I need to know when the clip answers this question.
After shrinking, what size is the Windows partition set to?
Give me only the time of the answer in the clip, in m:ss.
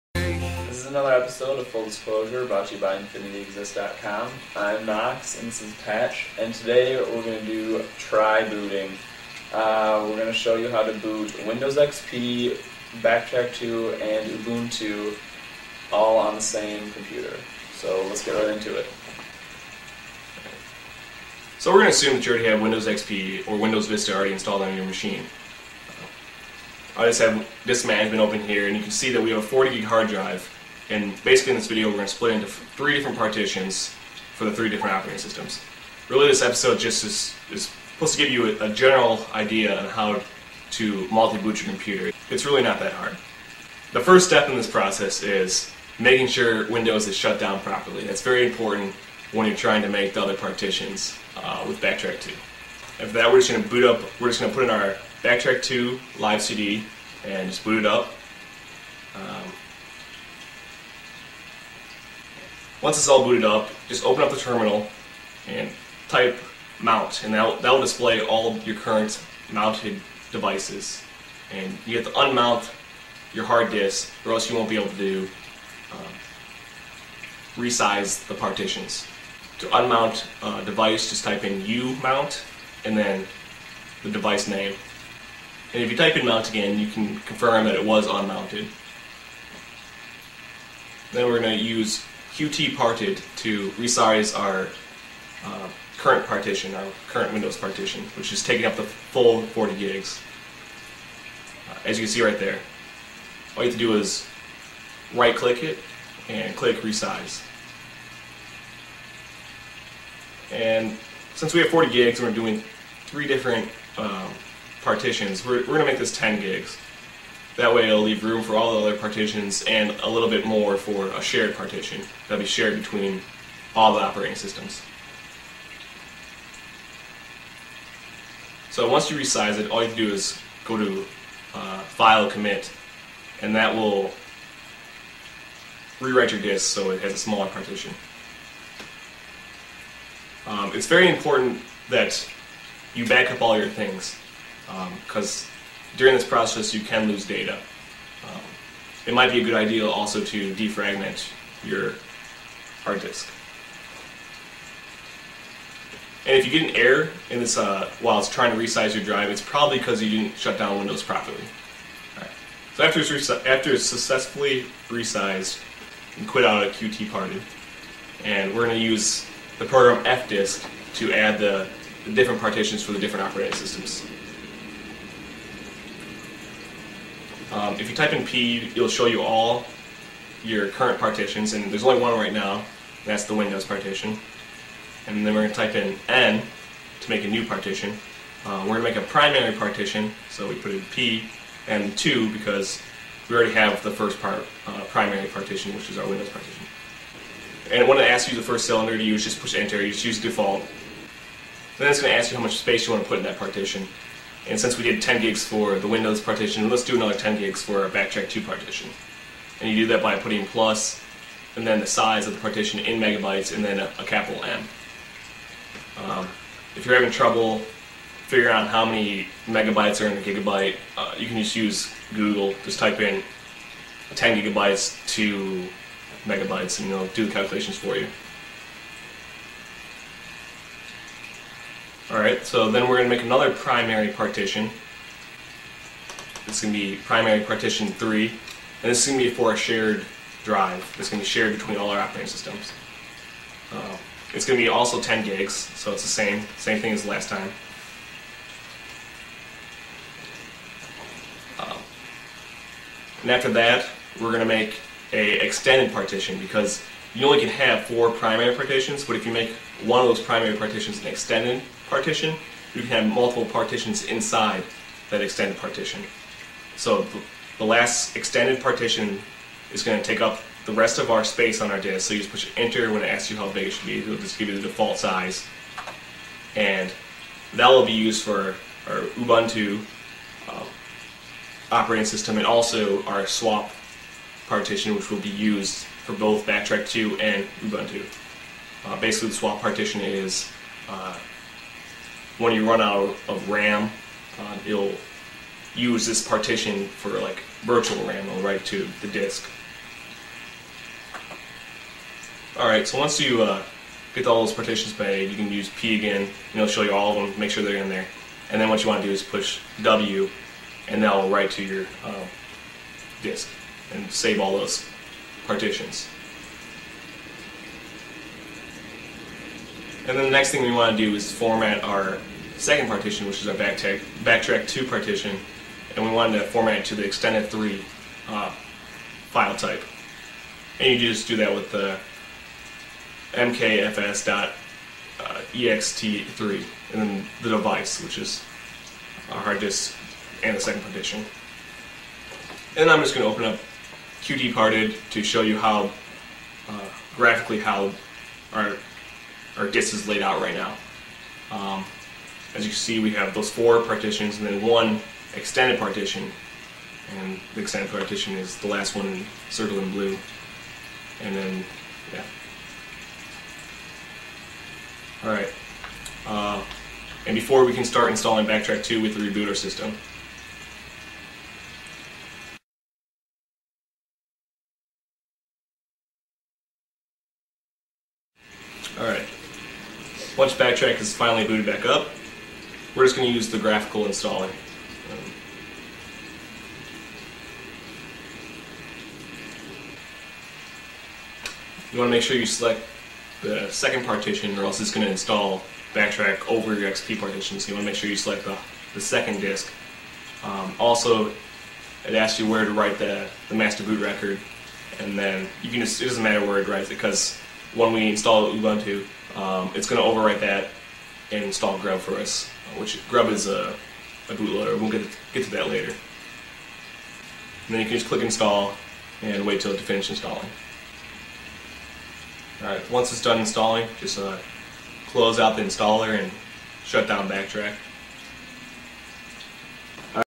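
1:55.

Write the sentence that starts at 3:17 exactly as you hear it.
And when it asks you the first cylinder to use, just push enter, you just use default.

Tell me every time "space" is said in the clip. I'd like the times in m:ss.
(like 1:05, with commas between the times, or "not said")
3:22, 4:31.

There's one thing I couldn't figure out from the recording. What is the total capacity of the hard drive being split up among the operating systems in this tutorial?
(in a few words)
40 gig.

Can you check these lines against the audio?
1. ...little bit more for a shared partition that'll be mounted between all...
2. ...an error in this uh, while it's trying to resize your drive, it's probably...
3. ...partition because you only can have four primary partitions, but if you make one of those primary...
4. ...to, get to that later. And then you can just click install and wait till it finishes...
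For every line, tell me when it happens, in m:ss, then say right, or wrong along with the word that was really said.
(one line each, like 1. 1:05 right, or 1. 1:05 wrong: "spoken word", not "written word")
1. 2:00 wrong: "shared", not "mounted"
2. 2:36 right
3. 4:15 right
4. 6:55 right.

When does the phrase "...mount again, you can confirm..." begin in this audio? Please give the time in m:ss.
1:26.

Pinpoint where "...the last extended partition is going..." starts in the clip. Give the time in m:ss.
4:27.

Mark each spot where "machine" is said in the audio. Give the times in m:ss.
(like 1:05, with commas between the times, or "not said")
0:24.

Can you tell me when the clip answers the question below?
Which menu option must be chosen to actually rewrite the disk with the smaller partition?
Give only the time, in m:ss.
2:11.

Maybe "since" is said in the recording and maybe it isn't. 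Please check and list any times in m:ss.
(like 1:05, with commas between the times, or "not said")
1:51, 3:24.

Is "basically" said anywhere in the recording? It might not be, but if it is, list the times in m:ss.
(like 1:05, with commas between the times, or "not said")
0:31, 4:48.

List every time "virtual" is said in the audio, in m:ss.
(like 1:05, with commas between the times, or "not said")
4:57.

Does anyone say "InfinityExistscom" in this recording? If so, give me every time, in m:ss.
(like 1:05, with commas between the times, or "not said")
0:02.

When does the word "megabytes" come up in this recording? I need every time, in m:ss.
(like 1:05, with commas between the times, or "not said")
3:32, 3:39, 3:46.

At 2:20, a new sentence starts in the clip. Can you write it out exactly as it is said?
Um, it's very important that you back up all your things because um, during this process, you can lose data.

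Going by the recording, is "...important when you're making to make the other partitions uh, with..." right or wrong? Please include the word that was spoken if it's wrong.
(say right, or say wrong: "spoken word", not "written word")
wrong: "trying", not "making".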